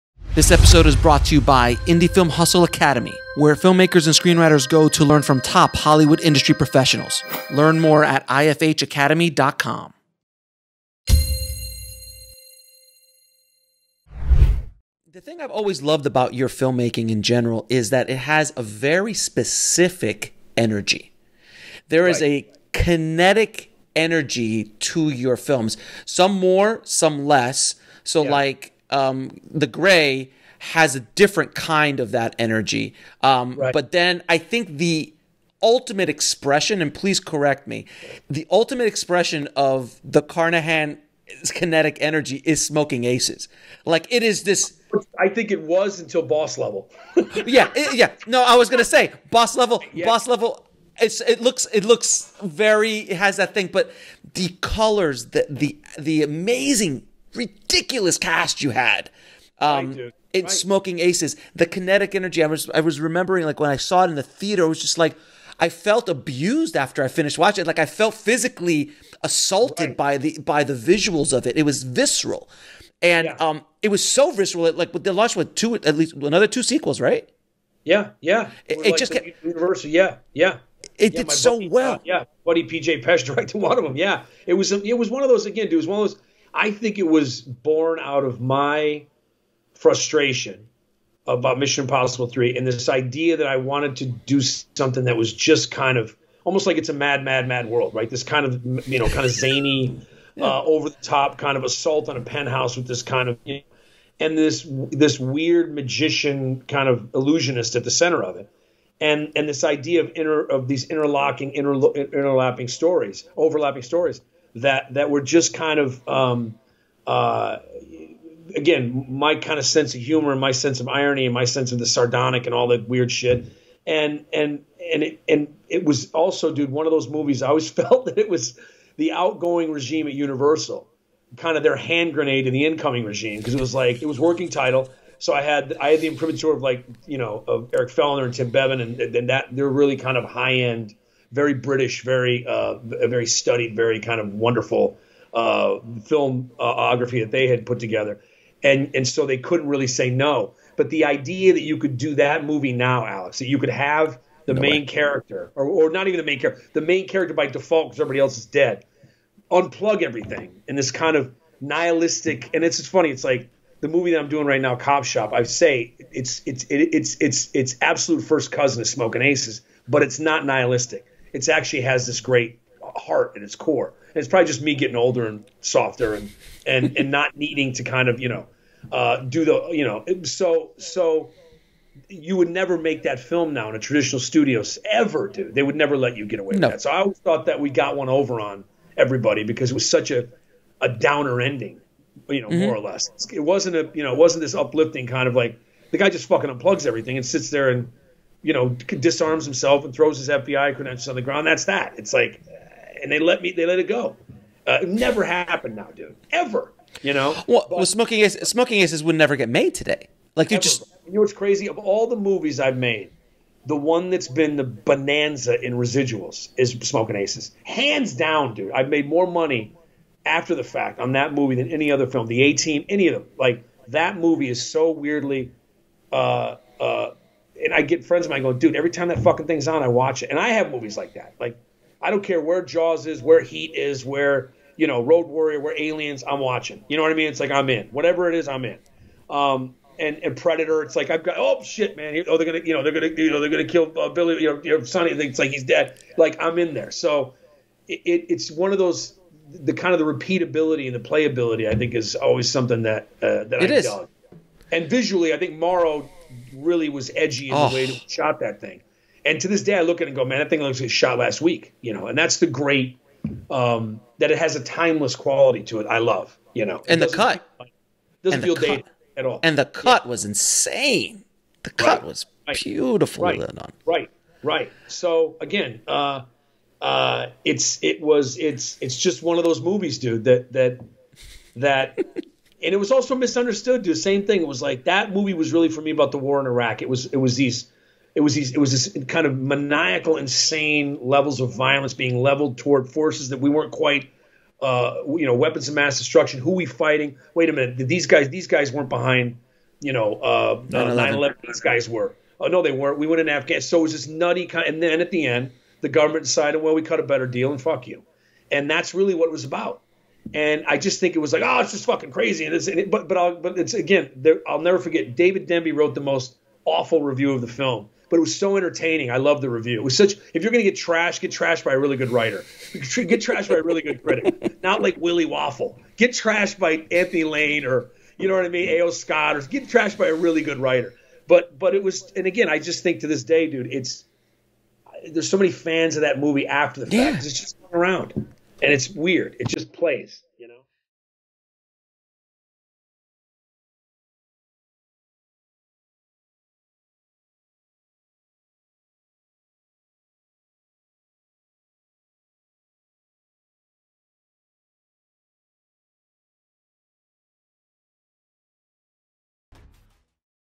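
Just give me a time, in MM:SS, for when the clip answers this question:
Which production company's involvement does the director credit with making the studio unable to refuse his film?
02:14.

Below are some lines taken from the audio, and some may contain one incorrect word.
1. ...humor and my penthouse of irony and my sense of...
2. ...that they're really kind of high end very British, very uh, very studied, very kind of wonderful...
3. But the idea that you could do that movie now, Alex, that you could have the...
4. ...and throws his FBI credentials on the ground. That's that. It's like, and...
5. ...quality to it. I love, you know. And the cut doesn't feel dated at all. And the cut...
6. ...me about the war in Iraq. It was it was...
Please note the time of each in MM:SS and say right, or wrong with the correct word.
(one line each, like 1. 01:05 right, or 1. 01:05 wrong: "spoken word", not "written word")
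1. 02:00 wrong: "sense", not "penthouse"
2. 02:19 right
3. 02:30 right
4. 03:19 right
5. 04:25 right
6. 04:45 right.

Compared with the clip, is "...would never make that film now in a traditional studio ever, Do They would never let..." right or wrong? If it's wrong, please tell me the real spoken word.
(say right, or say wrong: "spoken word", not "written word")
right.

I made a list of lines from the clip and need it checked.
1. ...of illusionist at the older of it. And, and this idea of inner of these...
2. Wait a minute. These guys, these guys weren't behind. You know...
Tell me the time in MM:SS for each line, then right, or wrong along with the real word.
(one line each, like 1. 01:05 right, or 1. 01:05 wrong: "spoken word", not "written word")
1. 01:46 wrong: "center", not "older"
2. 04:57 right.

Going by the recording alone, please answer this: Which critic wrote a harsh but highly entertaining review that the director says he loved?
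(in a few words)
David Denby.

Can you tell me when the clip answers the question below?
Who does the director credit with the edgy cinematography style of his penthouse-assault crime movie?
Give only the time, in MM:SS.
04:15.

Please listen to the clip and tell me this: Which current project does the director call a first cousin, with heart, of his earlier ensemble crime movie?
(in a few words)
Cop Shop.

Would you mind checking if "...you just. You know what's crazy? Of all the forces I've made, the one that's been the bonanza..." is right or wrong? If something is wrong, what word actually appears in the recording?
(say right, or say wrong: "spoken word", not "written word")
wrong: "movies", not "forces".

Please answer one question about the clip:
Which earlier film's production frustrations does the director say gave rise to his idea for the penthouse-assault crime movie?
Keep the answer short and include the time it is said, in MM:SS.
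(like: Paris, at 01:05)
Mission Impossible 3, at 01:31.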